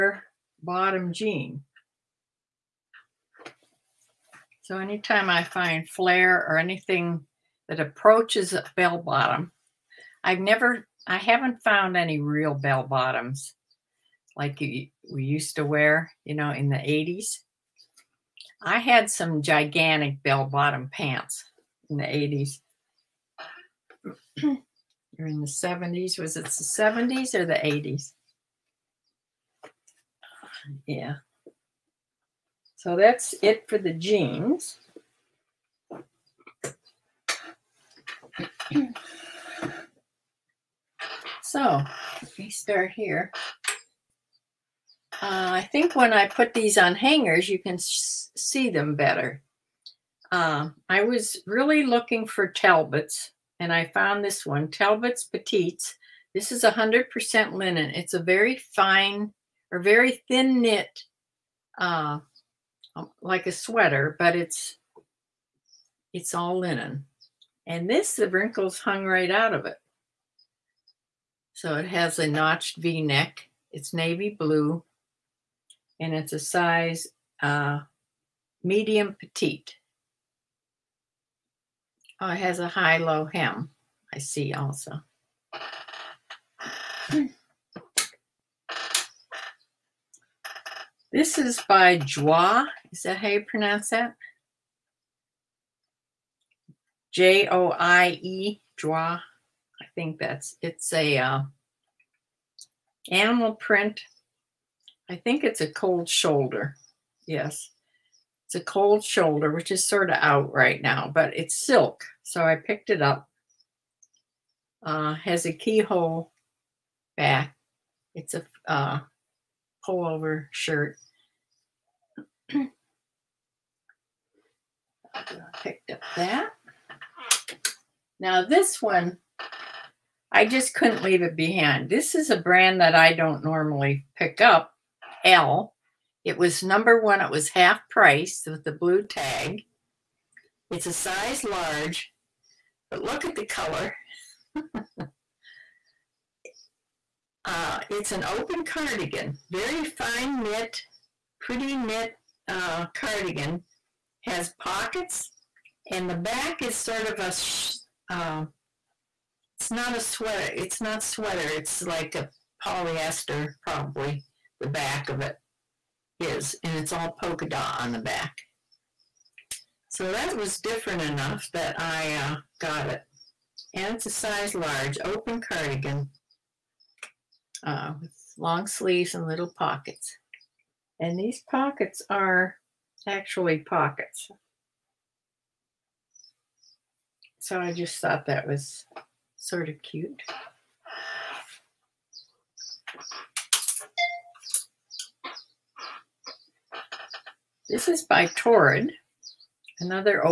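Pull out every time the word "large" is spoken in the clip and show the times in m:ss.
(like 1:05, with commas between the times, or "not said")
2:21, 2:54.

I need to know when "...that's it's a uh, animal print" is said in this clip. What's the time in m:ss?
1:40.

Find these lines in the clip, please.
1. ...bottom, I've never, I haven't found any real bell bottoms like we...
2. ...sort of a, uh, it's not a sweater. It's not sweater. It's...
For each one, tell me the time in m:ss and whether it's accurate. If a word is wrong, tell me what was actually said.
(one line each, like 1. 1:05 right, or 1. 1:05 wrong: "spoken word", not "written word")
1. 0:08 right
2. 2:36 right.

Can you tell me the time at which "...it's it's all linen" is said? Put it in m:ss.
1:04.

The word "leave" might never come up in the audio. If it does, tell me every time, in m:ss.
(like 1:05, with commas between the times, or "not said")
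2:11.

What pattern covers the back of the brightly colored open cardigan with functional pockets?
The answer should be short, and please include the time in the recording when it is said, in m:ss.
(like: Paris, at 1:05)
Polka dot, at 2:47.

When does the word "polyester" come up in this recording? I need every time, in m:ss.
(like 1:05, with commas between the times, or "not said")
2:42.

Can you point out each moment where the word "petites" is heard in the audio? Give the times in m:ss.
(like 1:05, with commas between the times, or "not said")
0:55, 1:19.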